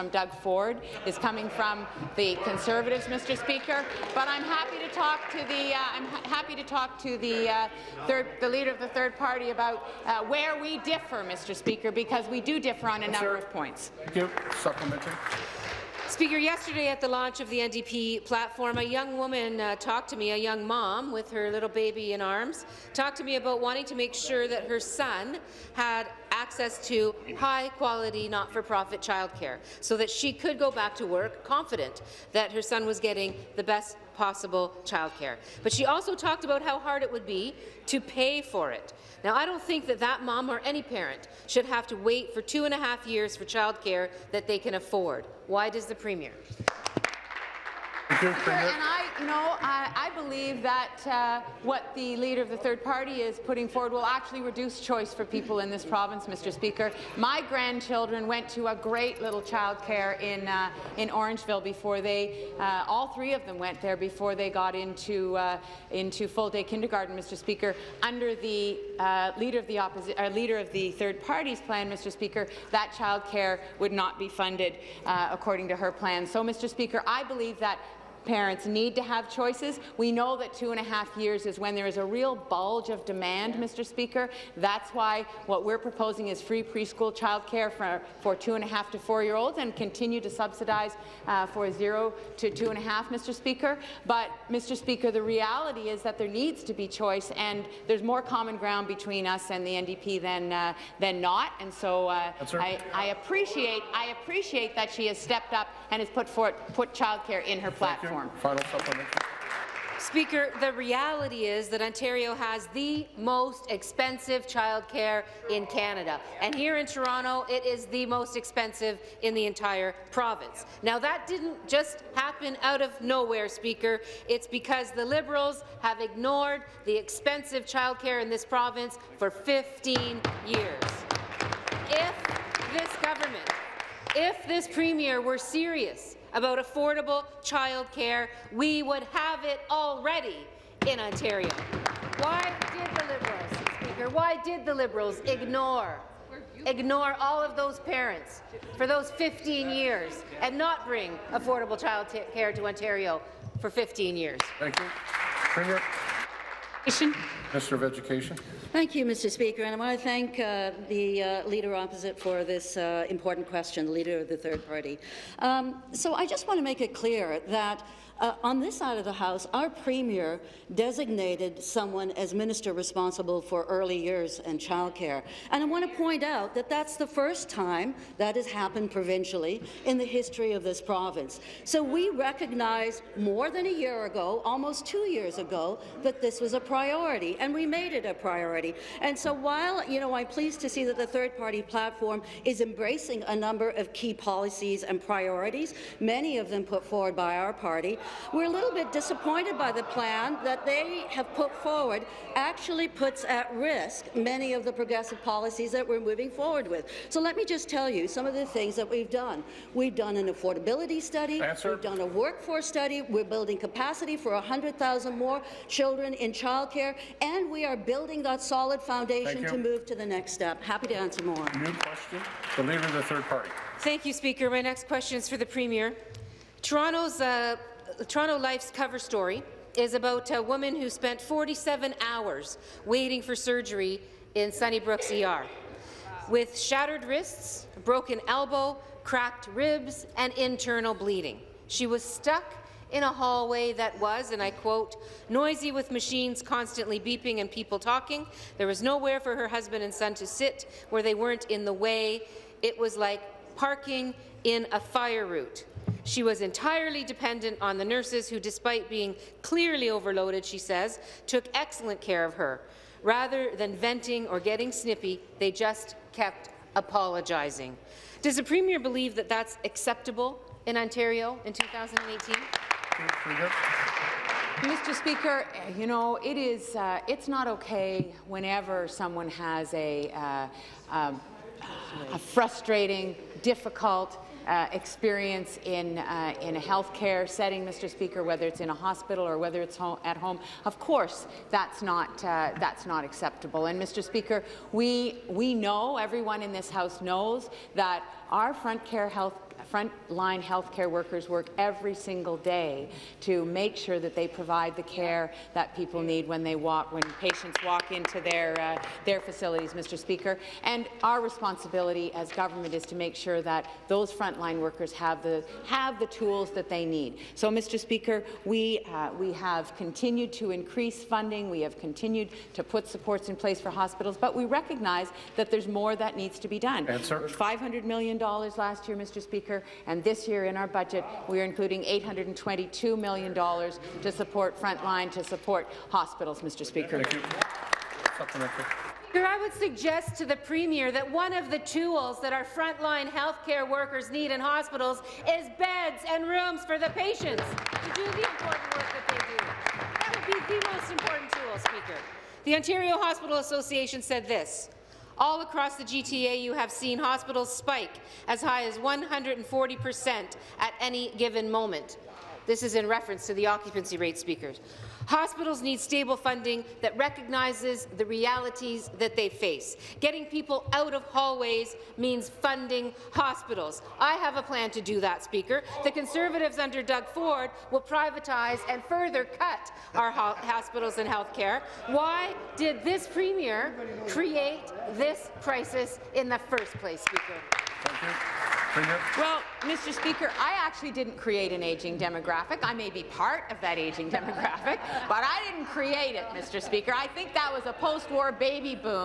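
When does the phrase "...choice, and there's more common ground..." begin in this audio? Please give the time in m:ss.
1:36.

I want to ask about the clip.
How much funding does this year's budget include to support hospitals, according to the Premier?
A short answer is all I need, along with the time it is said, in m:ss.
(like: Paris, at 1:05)
$822 million, at 5:31.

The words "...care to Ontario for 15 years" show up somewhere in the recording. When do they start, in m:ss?
2:32.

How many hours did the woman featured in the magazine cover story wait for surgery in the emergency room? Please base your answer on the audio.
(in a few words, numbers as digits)
47.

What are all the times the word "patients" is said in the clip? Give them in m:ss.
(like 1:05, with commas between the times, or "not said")
5:07, 5:46.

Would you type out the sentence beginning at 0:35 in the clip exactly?
But she also talked about how hard it would be to pay for it.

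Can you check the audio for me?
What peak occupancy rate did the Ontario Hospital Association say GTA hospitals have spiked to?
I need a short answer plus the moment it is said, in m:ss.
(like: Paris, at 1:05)
140 percent, at 5:58.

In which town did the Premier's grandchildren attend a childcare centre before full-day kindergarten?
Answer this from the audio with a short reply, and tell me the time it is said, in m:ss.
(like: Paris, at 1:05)
Orangeville, at 1:01.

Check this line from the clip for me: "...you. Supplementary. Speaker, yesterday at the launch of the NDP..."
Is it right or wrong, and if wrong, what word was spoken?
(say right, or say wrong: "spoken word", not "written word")
right.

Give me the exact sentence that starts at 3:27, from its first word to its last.
So let me just tell you some of the things that we've done.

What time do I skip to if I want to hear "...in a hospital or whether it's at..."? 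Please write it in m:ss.
4:48.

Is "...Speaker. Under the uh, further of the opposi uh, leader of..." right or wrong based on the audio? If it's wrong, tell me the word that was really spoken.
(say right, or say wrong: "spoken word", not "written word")
wrong: "leader", not "further".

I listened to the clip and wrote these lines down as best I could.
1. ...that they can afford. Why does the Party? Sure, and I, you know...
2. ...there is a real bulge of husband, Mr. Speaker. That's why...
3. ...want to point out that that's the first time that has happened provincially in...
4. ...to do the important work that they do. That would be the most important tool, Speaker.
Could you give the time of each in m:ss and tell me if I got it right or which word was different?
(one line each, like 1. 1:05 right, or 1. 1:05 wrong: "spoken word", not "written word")
1. 0:44 wrong: "Premier", not "Party"
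2. 1:21 wrong: "demand", not "husband"
3. 2:55 right
4. 5:47 right.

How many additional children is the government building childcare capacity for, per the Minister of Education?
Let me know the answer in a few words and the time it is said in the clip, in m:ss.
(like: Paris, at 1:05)
100,000, at 3:34.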